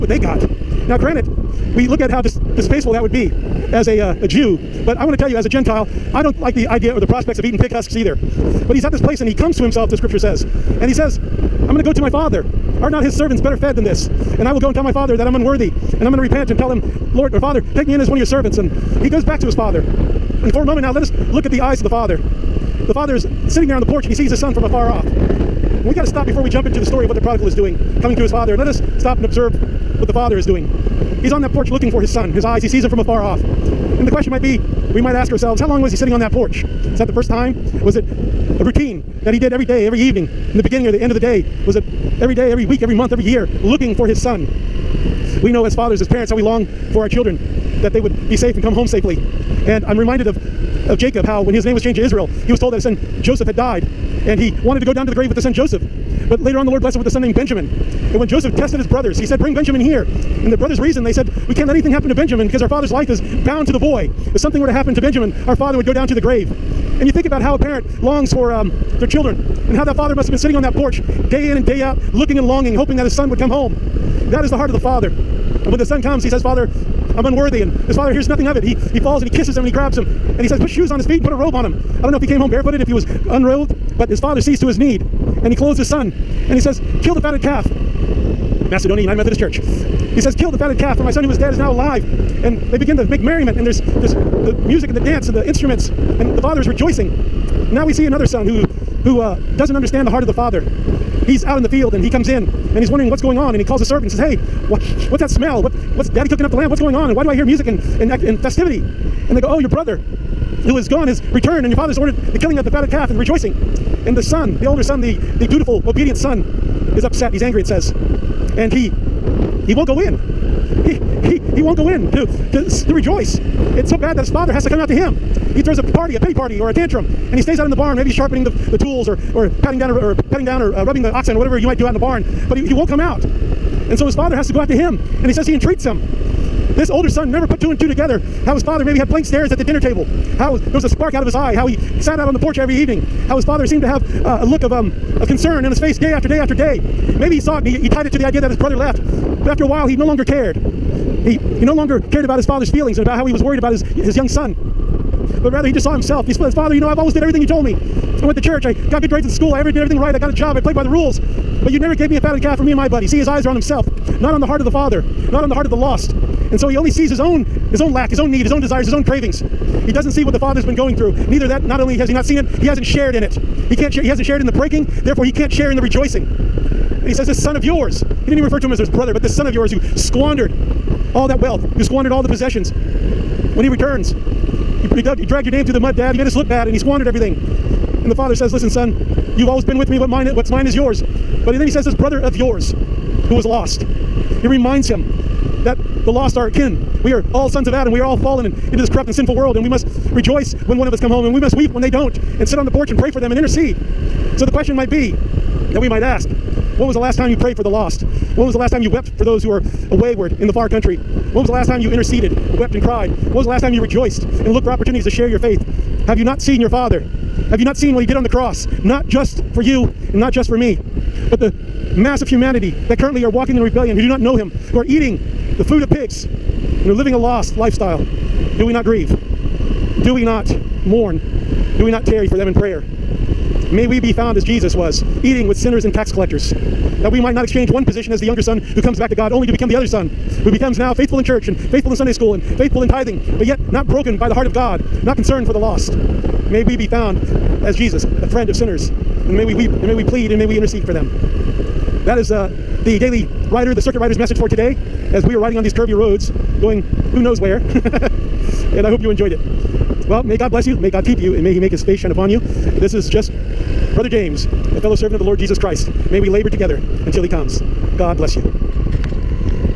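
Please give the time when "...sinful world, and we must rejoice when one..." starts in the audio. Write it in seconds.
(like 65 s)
199 s.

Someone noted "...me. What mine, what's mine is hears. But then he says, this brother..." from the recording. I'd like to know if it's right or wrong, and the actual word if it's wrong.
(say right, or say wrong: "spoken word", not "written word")
wrong: "yours", not "hears".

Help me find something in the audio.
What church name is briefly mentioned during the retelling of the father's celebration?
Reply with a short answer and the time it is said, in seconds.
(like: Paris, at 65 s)
Macedonia United Methodist Church, at 88 s.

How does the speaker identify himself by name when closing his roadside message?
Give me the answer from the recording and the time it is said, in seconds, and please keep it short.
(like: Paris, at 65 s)
Brother James, at 263 s.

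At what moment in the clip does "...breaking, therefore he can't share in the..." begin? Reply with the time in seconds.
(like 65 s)
174 s.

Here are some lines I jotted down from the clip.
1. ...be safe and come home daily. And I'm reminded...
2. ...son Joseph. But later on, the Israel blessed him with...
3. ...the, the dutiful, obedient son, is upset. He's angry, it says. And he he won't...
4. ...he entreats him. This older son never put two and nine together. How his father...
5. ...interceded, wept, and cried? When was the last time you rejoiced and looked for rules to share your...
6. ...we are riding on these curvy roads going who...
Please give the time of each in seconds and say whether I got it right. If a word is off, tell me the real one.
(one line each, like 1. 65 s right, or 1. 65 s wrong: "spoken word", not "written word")
1. 48 s wrong: "safely", not "daily"
2. 55 s wrong: "Lord", not "Israel"
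3. 115 s right
4. 135 s wrong: "two", not "nine"
5. 211 s wrong: "opportunities", not "rules"
6. 255 s right.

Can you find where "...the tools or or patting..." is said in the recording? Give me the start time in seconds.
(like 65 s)
128 s.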